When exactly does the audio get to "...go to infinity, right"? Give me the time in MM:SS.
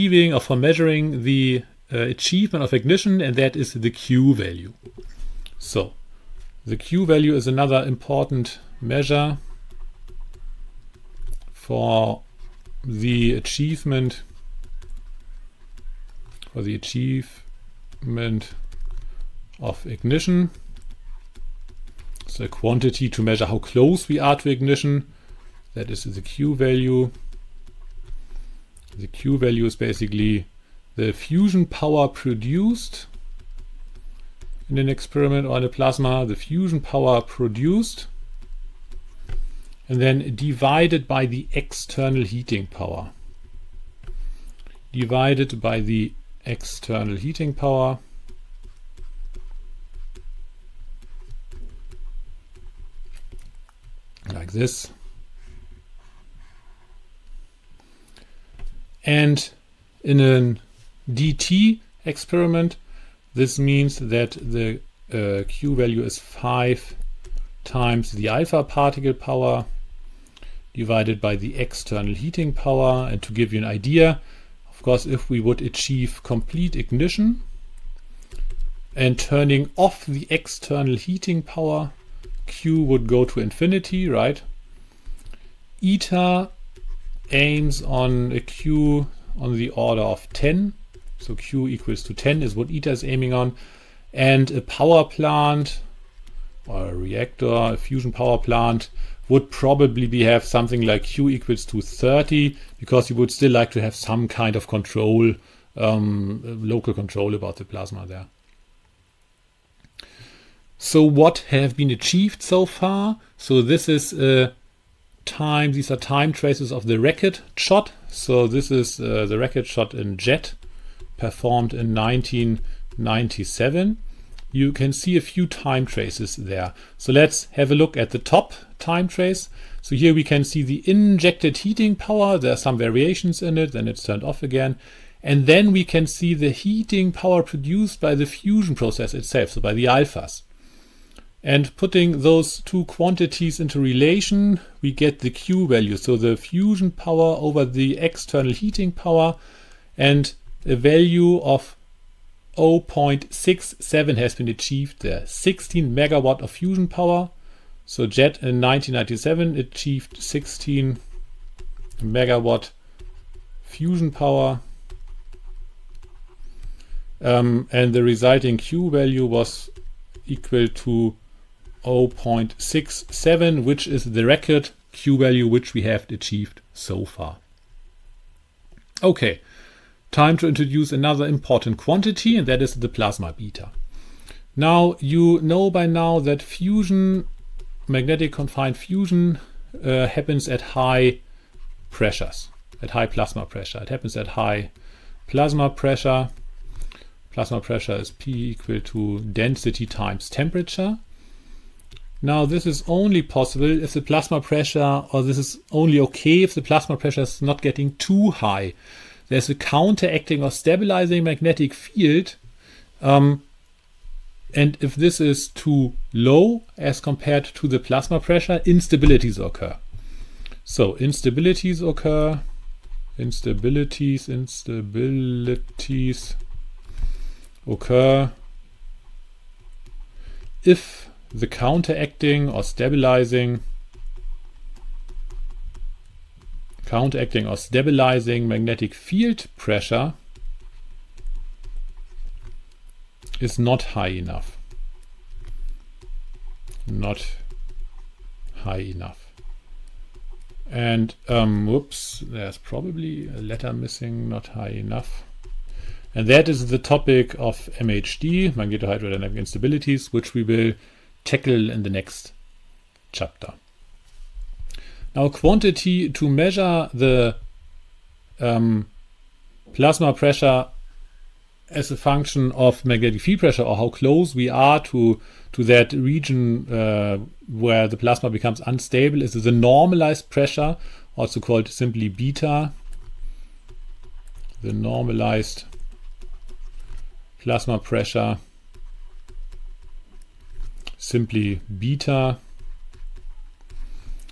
01:23.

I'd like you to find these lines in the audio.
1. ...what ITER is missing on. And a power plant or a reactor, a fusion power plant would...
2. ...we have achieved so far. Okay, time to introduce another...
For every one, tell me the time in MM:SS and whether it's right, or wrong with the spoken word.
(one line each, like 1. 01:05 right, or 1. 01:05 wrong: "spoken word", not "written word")
1. 01:32 wrong: "aiming", not "missing"
2. 02:55 right.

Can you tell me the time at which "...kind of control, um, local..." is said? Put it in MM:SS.
01:44.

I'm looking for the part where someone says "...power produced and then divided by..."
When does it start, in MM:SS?
00:36.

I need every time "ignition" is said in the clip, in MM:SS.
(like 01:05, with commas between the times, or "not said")
00:02, 00:19, 00:24, 01:16.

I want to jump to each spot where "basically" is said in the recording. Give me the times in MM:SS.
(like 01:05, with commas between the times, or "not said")
00:29.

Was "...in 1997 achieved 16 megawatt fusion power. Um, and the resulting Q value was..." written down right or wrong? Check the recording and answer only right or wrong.
right.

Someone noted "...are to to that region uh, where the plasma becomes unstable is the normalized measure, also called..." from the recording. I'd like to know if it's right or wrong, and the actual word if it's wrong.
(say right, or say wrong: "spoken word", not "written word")
wrong: "pressure", not "measure".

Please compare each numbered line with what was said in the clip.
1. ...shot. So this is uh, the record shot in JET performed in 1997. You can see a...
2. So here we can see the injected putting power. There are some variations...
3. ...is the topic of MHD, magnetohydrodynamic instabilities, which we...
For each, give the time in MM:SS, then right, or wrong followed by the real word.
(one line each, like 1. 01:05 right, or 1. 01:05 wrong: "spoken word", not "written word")
1. 01:57 right
2. 02:09 wrong: "heating", not "putting"
3. 04:16 right.